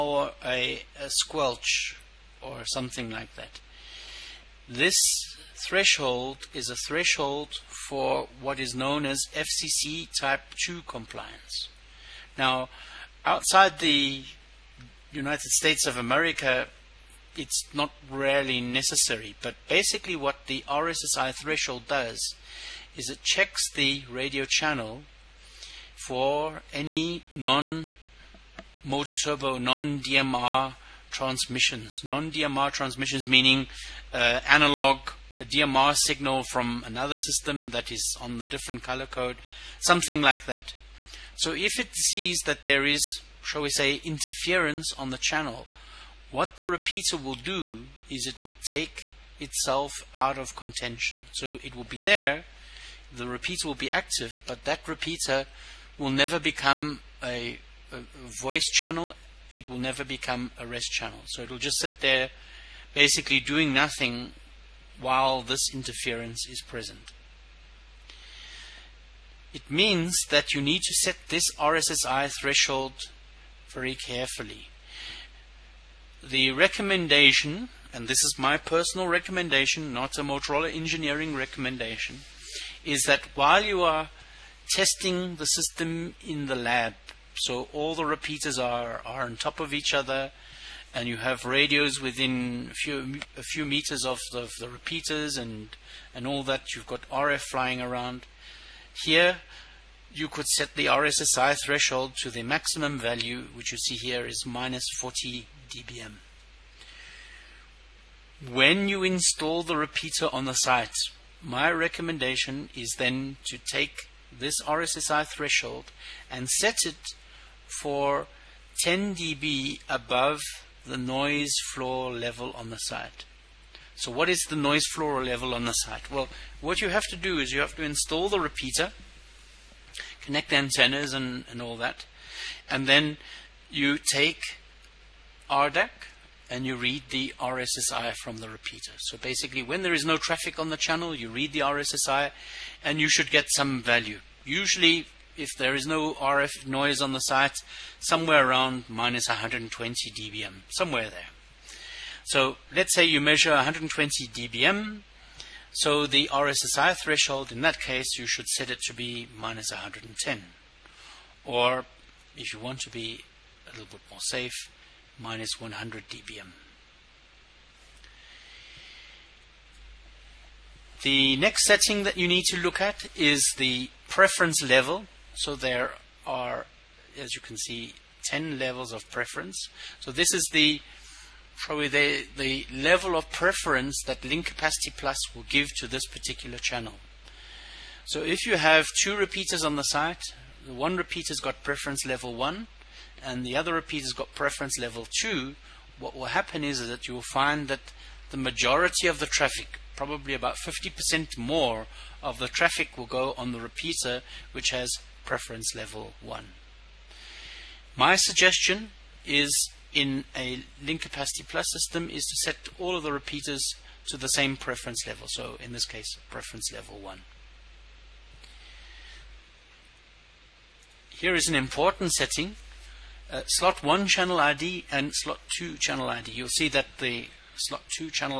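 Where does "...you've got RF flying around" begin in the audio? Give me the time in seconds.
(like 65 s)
96 s.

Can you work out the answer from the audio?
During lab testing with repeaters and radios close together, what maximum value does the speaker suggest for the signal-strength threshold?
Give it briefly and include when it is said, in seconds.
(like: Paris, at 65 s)
-40 dBm, at 104 s.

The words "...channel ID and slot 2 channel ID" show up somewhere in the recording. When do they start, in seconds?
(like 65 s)
224 s.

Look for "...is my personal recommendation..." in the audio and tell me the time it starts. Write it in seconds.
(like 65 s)
78 s.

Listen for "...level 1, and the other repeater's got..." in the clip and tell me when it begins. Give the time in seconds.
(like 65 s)
192 s.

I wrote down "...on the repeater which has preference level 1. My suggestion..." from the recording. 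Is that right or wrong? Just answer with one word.
right.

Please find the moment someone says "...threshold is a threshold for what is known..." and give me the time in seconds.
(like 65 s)
5 s.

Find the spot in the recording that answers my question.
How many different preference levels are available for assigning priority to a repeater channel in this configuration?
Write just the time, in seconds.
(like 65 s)
178 s.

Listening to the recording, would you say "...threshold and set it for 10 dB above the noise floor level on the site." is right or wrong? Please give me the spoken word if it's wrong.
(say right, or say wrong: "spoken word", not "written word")
right.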